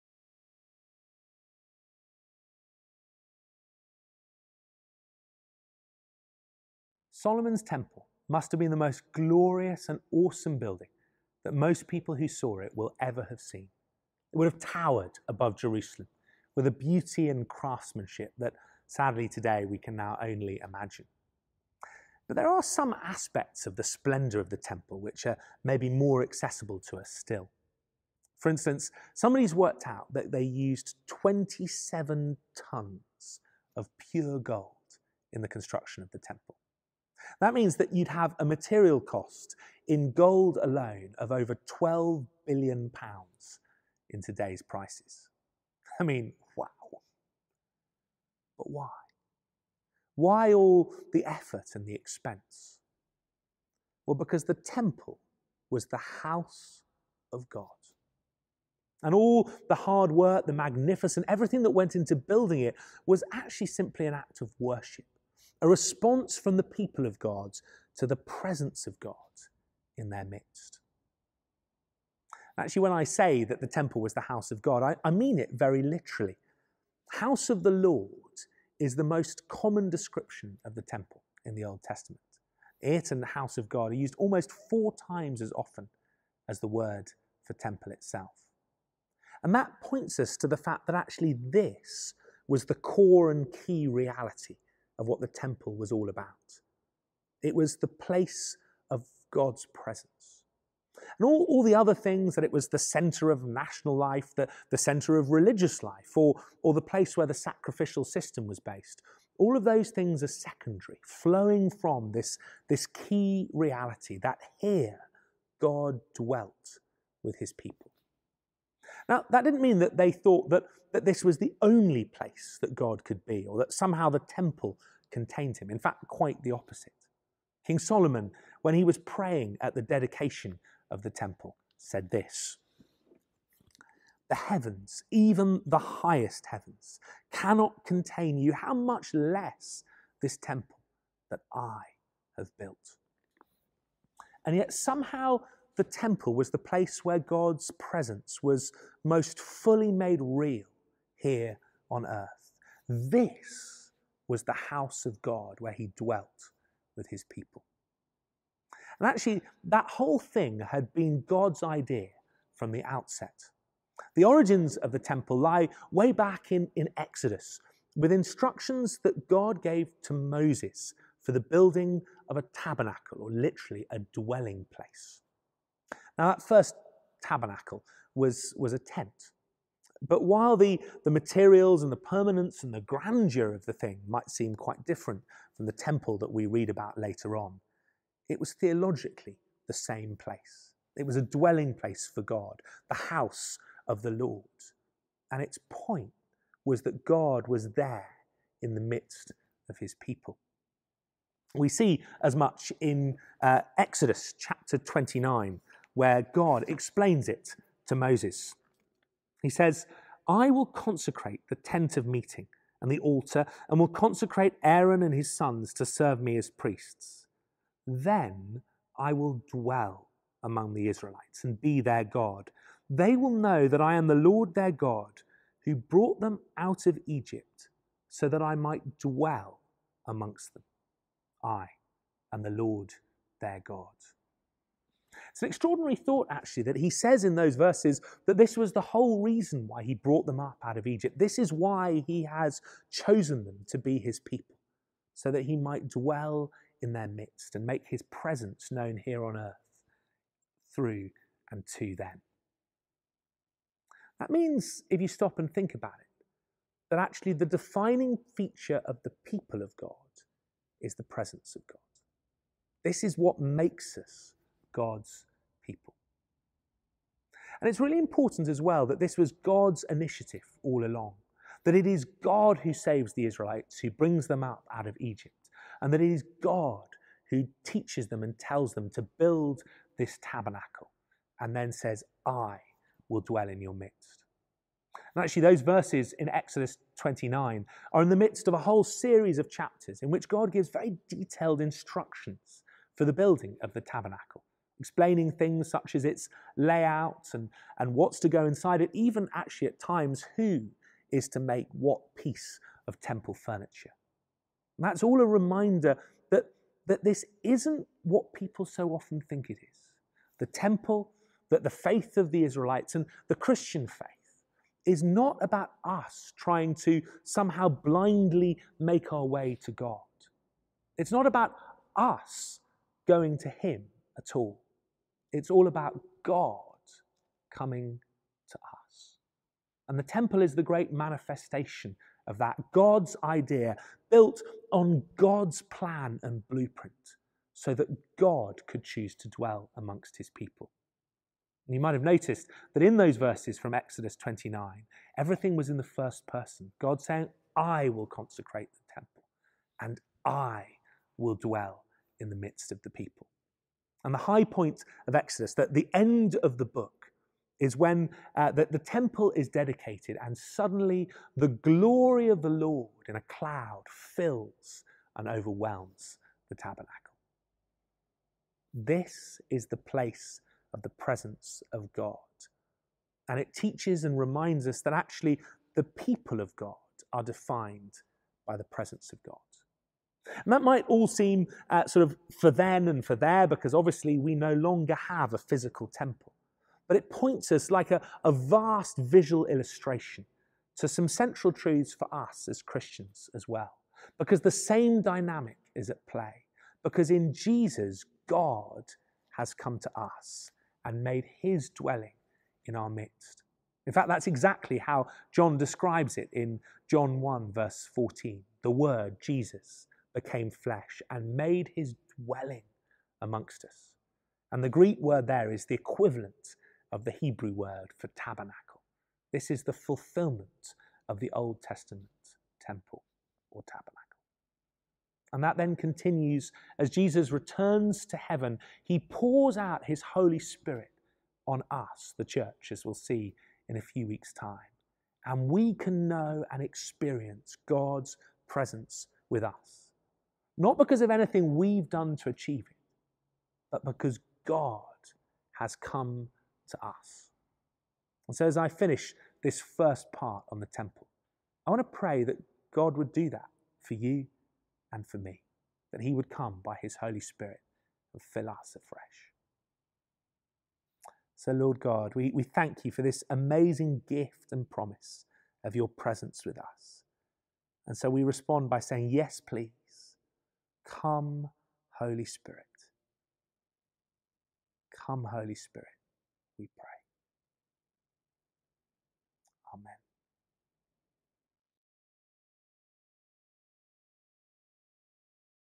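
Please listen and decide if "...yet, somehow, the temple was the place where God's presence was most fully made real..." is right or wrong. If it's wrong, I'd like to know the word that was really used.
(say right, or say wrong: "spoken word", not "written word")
right.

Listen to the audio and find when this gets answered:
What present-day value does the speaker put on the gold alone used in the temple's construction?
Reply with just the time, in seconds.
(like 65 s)
41 s.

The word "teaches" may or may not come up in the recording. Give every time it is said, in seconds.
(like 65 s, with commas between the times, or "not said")
277 s, 373 s.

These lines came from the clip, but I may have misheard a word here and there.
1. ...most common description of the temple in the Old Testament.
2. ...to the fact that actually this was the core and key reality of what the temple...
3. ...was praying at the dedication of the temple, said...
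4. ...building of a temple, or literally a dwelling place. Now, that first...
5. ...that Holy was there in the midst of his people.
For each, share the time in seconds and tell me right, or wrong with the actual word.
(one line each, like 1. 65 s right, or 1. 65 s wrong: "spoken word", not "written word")
1. 79 s right
2. 90 s right
3. 128 s right
4. 171 s wrong: "tabernacle", not "temple"
5. 196 s wrong: "God", not "Holy".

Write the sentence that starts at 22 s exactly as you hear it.
But there are some aspects of the splendour of the temple which are maybe more accessible to us still.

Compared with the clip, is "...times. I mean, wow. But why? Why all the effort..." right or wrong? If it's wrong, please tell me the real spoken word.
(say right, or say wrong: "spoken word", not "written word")
wrong: "prices", not "times".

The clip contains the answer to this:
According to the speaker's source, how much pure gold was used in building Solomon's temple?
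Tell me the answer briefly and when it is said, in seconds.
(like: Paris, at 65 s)
27 tons, at 31 s.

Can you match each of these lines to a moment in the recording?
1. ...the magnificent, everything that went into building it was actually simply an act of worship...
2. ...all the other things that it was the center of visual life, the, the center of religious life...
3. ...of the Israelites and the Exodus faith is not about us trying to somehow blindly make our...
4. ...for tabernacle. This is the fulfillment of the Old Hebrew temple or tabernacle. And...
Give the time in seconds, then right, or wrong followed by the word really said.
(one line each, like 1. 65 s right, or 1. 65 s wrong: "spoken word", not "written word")
1. 60 s right
2. 101 s wrong: "national", not "visual"
3. 312 s wrong: "Christian", not "Exodus"
4. 417 s wrong: "Testament", not "Hebrew".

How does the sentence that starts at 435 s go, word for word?
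And we can know and experience God's presence with us.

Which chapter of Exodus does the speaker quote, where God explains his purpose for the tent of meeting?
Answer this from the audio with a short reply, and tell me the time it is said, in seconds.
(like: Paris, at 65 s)
Chapter 29, at 204 s.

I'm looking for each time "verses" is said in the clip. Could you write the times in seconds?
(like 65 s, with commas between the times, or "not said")
237 s, 285 s, 343 s, 407 s.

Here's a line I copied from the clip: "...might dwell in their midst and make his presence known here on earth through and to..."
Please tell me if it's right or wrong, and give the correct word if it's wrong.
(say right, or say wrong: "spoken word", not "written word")
right.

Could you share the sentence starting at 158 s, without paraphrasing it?
And actually, that whole thing had been God's idea from the outset.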